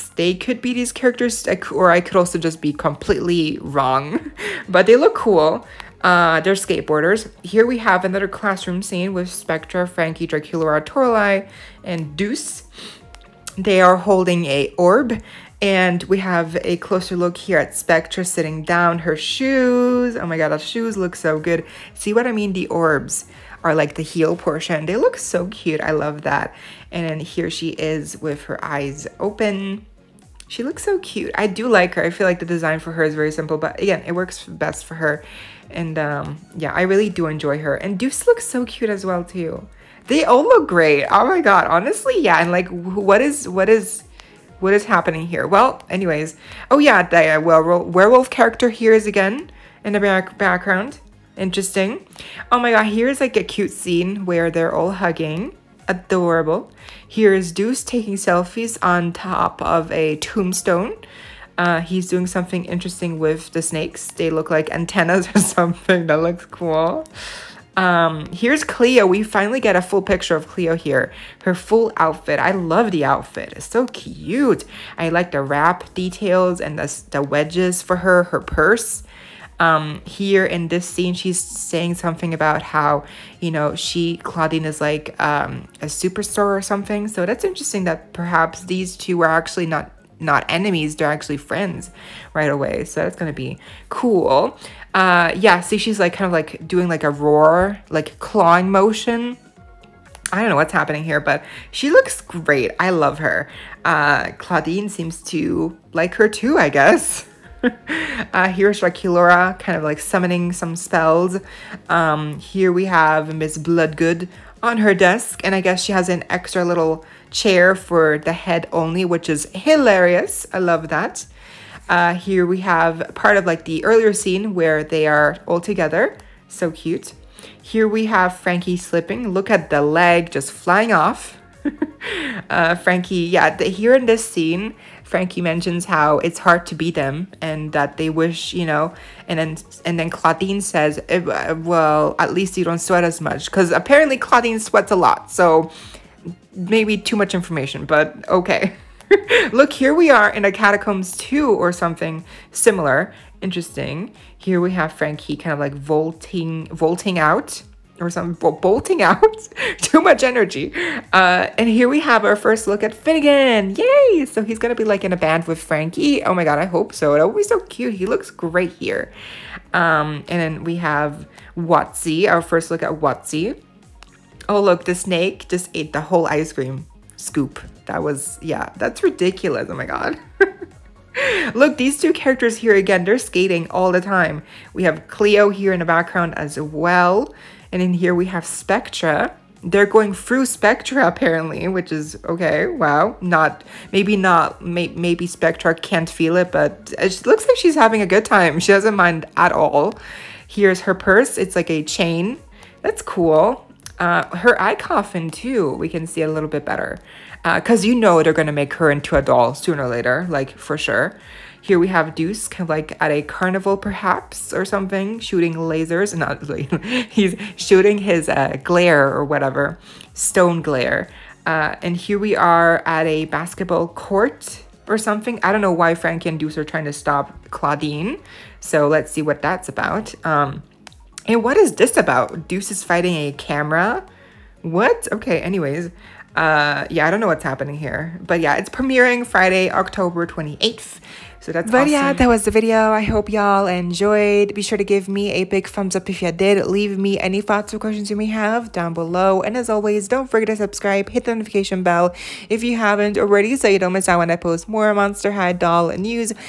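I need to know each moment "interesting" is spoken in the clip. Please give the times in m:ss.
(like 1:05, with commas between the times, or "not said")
0:51, 1:02, 1:27, 2:33.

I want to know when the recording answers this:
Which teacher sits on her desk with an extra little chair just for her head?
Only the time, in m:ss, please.
1:53.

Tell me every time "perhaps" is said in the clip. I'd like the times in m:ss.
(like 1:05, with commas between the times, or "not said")
1:28, 3:33.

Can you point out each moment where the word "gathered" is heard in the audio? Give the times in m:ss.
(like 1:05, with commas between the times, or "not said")
not said.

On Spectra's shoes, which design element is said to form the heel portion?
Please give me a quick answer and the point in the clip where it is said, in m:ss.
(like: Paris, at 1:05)
The orbs, at 0:22.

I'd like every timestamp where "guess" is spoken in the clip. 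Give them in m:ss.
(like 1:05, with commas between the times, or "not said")
1:46, 1:55.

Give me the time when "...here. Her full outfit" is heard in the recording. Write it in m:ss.
1:10.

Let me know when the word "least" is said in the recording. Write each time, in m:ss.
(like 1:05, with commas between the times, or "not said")
2:22.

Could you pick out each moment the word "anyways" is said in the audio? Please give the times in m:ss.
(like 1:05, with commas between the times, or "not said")
0:45, 3:55.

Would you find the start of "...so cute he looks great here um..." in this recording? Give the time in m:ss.
2:47.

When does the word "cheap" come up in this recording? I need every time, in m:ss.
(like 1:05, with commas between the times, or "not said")
not said.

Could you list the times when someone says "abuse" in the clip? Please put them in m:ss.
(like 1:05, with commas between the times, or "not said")
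not said.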